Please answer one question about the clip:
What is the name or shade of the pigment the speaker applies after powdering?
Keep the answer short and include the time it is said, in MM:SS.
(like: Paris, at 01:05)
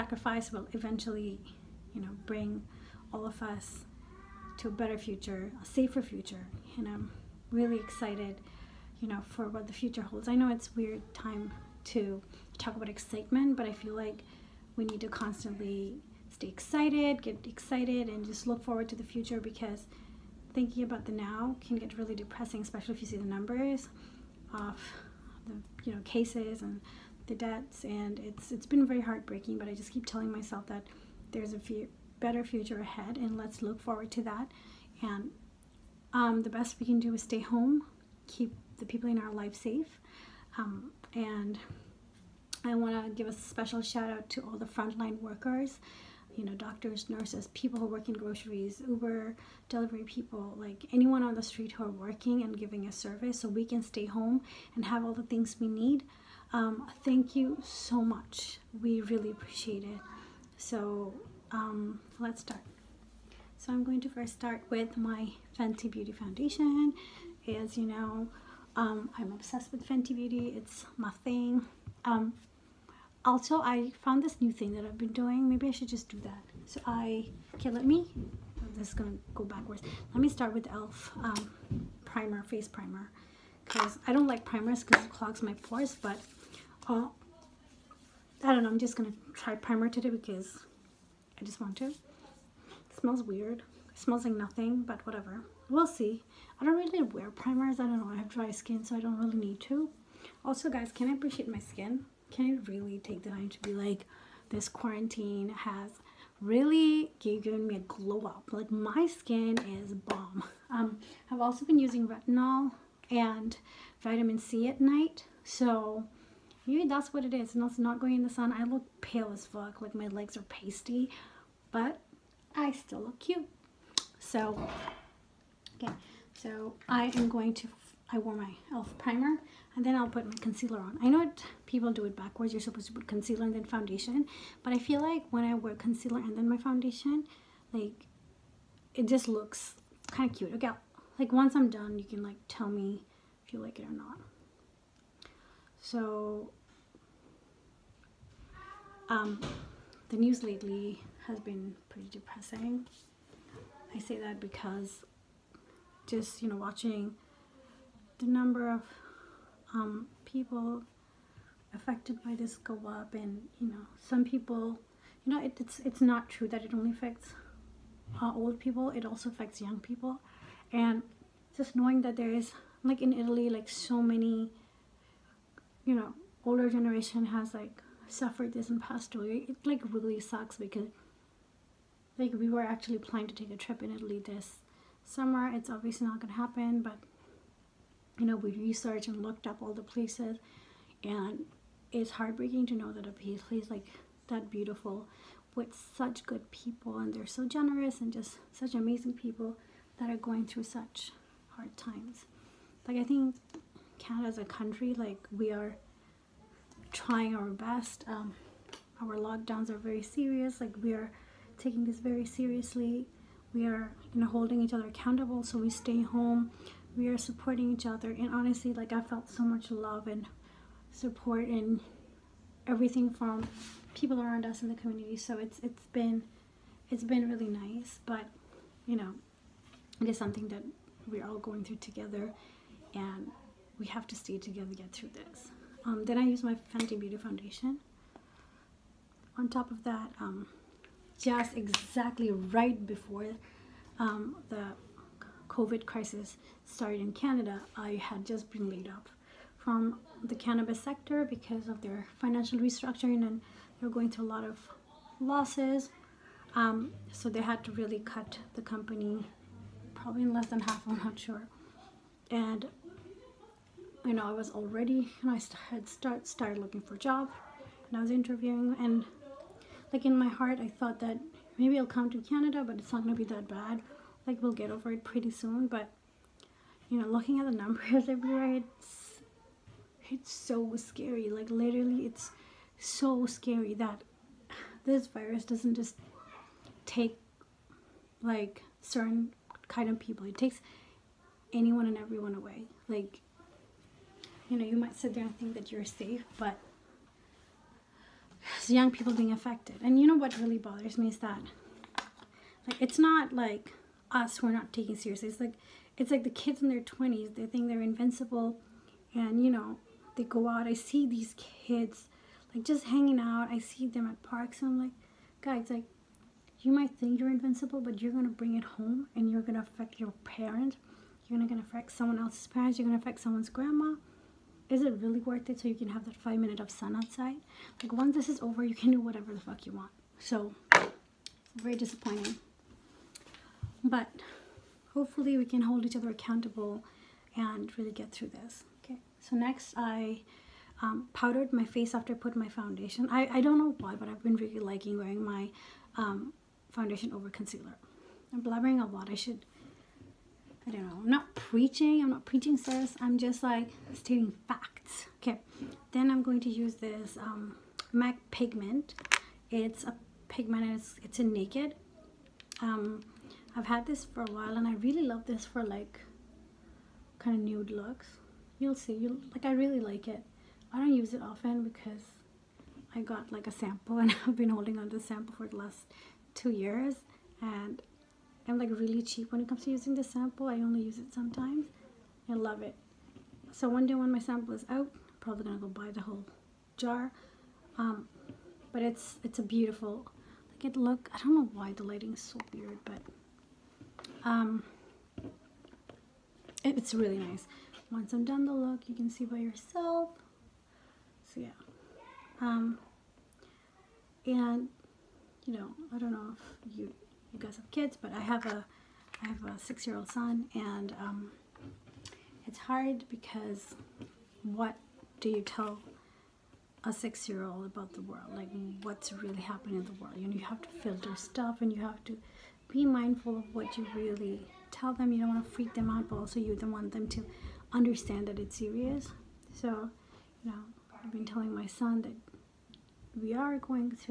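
Naked, at 06:01.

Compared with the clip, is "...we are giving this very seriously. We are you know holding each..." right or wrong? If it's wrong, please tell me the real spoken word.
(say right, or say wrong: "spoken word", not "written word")
wrong: "taking", not "giving".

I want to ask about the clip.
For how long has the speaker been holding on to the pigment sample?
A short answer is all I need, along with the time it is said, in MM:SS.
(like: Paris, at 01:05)
2 years, at 06:16.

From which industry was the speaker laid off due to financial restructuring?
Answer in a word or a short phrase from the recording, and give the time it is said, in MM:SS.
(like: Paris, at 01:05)
Cannabis, at 04:10.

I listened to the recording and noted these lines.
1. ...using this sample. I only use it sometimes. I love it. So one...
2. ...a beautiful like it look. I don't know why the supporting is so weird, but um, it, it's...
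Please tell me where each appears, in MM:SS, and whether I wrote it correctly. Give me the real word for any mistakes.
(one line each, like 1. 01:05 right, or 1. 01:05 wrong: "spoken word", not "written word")
1. 06:19 right
2. 06:29 wrong: "lighting", not "supporting".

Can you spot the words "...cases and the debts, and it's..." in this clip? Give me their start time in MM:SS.
00:26.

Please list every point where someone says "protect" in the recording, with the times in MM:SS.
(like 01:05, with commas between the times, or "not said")
not said.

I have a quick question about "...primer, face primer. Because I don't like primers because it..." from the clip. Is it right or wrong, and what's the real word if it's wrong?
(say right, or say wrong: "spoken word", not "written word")
right.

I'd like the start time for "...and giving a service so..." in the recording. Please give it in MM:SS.
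00:52.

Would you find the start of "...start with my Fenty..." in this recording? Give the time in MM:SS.
01:04.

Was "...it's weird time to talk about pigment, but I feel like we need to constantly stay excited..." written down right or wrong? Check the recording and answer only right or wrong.
wrong.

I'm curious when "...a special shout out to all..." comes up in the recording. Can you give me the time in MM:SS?
00:43.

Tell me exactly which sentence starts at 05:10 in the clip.
I see these kids, like, just hanging out.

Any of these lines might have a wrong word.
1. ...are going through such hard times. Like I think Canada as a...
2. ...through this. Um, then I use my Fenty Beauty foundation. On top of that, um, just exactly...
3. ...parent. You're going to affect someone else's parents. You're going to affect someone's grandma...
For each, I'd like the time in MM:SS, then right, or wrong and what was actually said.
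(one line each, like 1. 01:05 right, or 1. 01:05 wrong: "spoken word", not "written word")
1. 03:20 right
2. 03:54 right
3. 05:20 right.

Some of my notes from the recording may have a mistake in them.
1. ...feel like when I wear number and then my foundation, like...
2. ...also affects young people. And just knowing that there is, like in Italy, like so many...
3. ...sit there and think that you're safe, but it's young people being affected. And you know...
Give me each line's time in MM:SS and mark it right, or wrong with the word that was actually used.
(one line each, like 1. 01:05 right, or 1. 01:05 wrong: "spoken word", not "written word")
1. 02:14 wrong: "concealer", not "number"
2. 02:49 right
3. 04:54 right.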